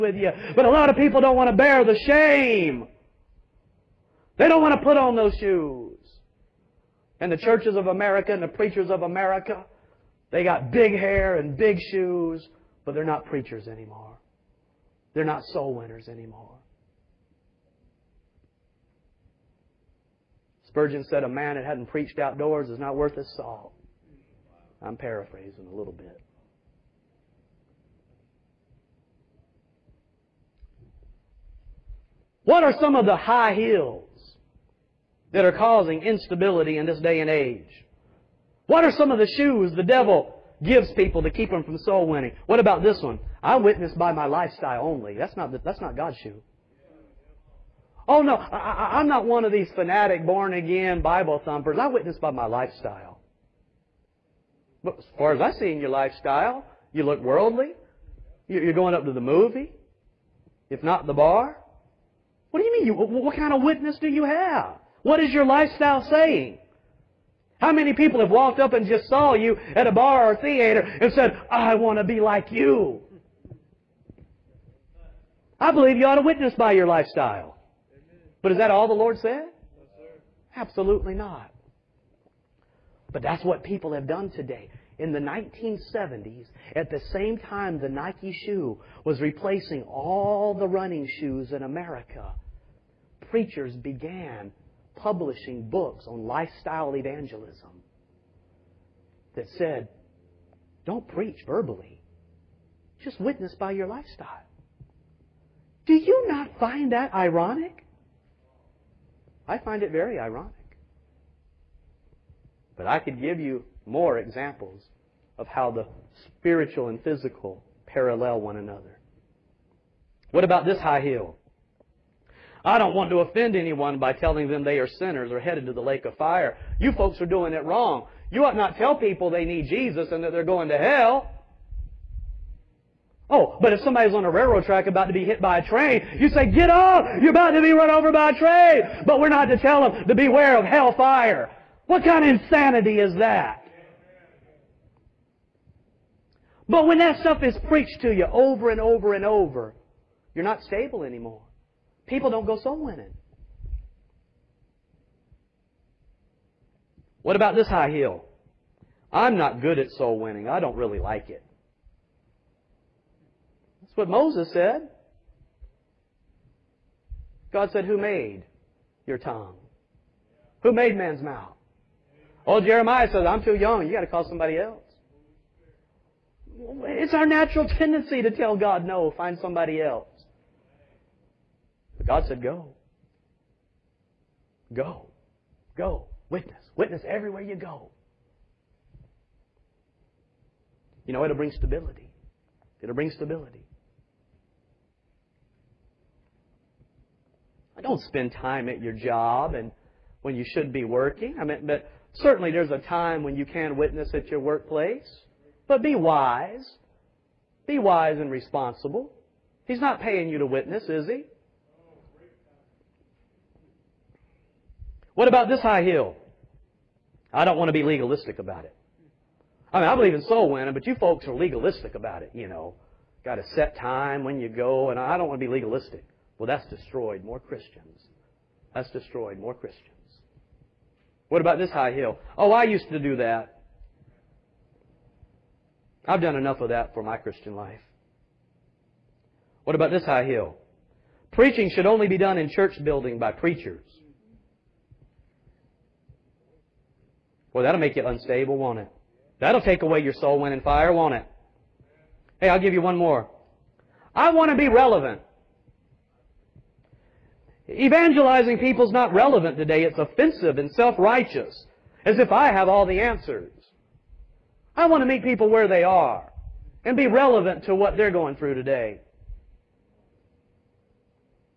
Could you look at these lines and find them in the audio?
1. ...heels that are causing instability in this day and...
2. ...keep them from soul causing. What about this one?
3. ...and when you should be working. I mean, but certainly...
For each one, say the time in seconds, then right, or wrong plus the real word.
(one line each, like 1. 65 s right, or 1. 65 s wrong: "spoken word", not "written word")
1. 33 s right
2. 41 s wrong: "winning", not "causing"
3. 199 s right.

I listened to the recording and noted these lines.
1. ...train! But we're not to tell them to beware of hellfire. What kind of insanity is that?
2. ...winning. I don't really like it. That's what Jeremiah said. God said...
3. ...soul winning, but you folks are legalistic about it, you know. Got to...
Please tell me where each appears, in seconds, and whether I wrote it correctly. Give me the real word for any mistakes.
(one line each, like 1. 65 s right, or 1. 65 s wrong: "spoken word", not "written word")
1. 138 s right
2. 160 s wrong: "Moses", not "Jeremiah"
3. 220 s right.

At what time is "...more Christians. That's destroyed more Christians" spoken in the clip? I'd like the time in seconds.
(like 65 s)
227 s.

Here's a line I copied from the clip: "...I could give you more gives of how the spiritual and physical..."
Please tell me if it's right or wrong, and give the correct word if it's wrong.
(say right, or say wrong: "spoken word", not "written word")
wrong: "examples", not "gives".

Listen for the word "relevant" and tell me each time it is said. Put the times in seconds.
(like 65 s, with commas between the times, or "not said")
254 s, 259 s, 267 s.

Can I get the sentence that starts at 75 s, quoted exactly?
I believe you ought to witness by your lifestyle.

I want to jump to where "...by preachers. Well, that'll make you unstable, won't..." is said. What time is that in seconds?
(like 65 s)
243 s.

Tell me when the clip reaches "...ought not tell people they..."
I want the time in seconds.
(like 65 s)
128 s.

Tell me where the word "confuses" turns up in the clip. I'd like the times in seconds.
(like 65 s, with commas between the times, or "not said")
not said.